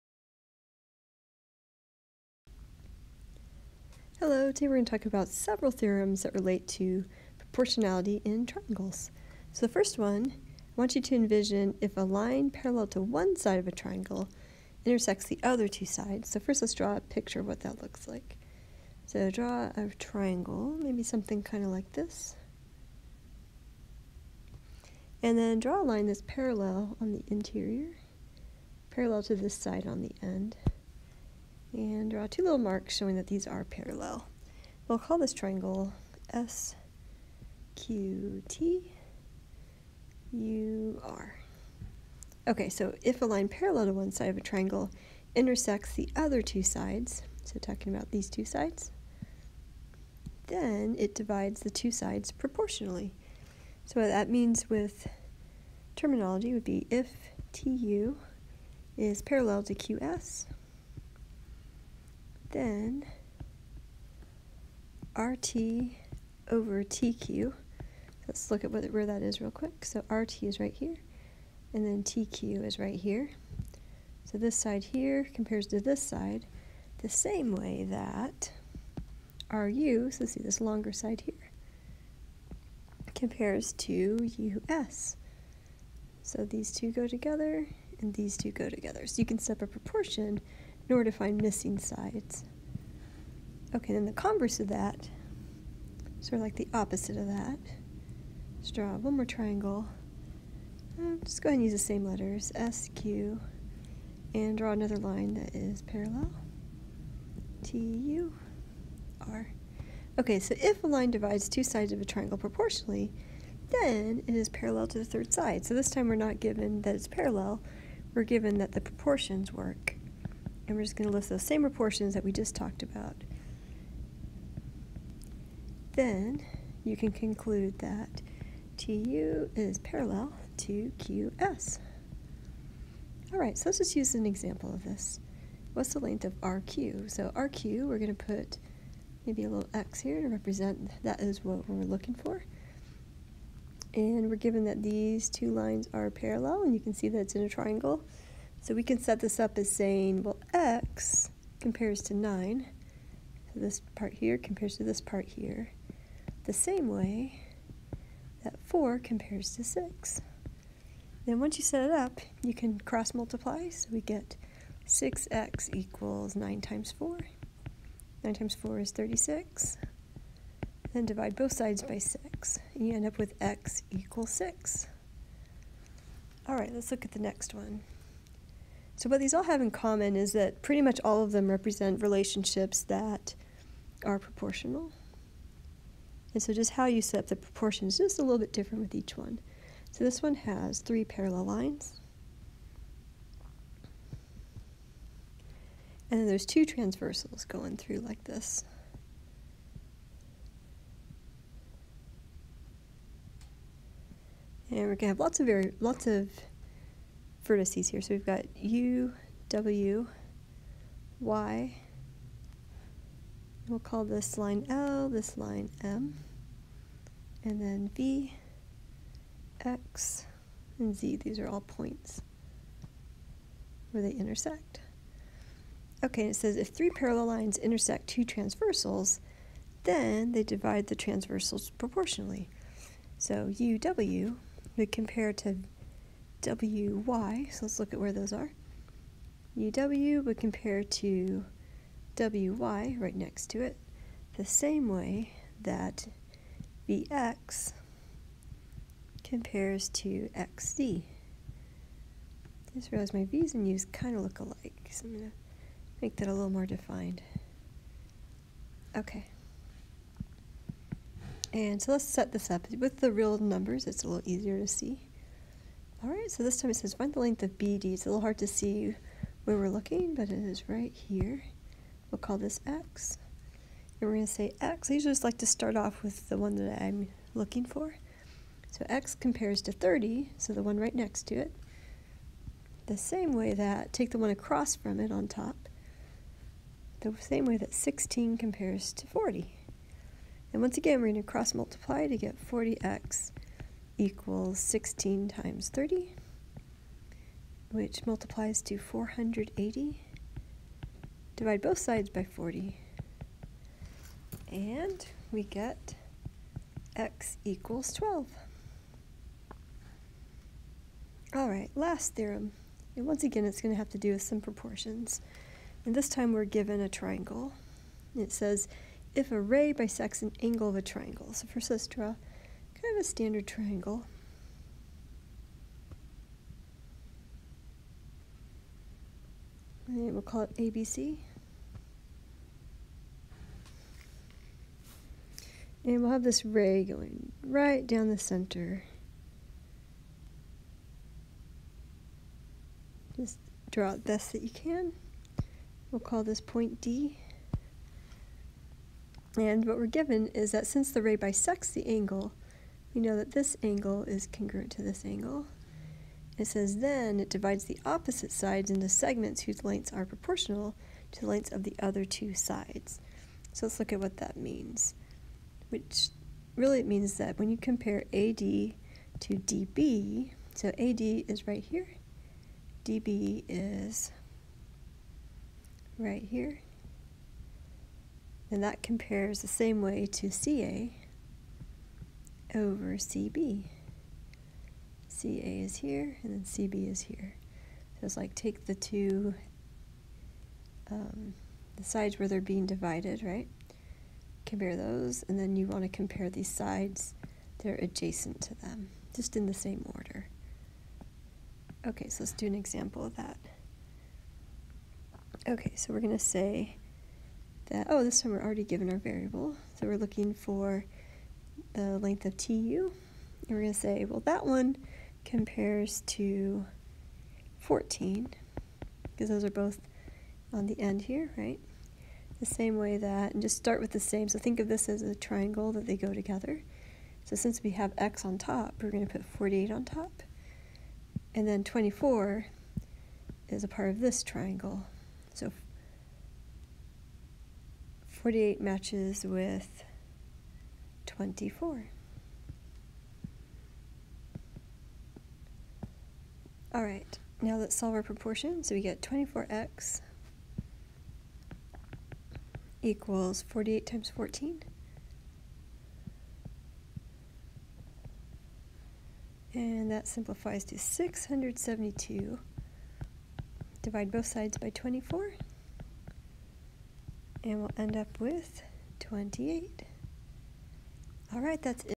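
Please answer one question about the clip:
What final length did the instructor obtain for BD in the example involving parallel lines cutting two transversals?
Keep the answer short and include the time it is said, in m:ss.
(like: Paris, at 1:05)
12, at 5:06.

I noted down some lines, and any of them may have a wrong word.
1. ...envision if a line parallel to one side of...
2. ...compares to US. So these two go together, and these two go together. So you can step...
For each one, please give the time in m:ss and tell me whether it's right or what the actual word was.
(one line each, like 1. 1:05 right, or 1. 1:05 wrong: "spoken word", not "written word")
1. 0:11 right
2. 1:23 right.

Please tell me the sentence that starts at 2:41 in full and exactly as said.
Then once you set it up, you can cross multiply.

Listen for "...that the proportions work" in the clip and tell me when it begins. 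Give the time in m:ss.
1:58.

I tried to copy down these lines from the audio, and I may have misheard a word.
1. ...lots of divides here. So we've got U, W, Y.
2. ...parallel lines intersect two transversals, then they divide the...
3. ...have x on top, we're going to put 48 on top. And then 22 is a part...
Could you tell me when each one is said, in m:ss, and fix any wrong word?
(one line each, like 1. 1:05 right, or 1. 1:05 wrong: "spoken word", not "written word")
1. 3:25 wrong: "vertices", not "divides"
2. 3:46 right
3. 7:07 wrong: "24", not "22".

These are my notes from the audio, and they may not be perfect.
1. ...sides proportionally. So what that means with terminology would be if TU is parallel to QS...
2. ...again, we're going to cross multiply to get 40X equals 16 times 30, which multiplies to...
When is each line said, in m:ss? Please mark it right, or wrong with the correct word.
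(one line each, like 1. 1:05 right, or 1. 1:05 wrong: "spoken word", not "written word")
1. 0:51 right
2. 4:50 right.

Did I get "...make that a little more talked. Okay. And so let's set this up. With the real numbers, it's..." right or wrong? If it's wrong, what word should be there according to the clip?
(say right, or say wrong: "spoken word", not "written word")
wrong: "defined", not "talked".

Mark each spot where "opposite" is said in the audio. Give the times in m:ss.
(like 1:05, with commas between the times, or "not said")
1:36, 5:57.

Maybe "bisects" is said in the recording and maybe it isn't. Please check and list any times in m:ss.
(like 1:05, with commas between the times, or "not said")
5:19, 5:51.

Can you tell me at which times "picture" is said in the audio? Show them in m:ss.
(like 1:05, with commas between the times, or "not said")
0:17.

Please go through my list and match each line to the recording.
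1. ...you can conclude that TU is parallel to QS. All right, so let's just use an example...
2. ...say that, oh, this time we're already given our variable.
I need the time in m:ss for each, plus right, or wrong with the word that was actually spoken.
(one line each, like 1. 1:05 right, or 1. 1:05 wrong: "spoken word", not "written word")
1. 2:06 right
2. 6:46 right.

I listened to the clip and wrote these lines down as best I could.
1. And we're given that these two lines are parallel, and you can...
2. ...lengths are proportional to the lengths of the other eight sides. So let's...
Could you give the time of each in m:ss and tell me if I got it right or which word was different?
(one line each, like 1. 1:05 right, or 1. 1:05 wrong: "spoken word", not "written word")
1. 2:23 right
2. 5:59 wrong: "two", not "eight".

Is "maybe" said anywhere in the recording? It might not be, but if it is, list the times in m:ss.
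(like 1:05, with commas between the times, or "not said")
0:20, 2:19.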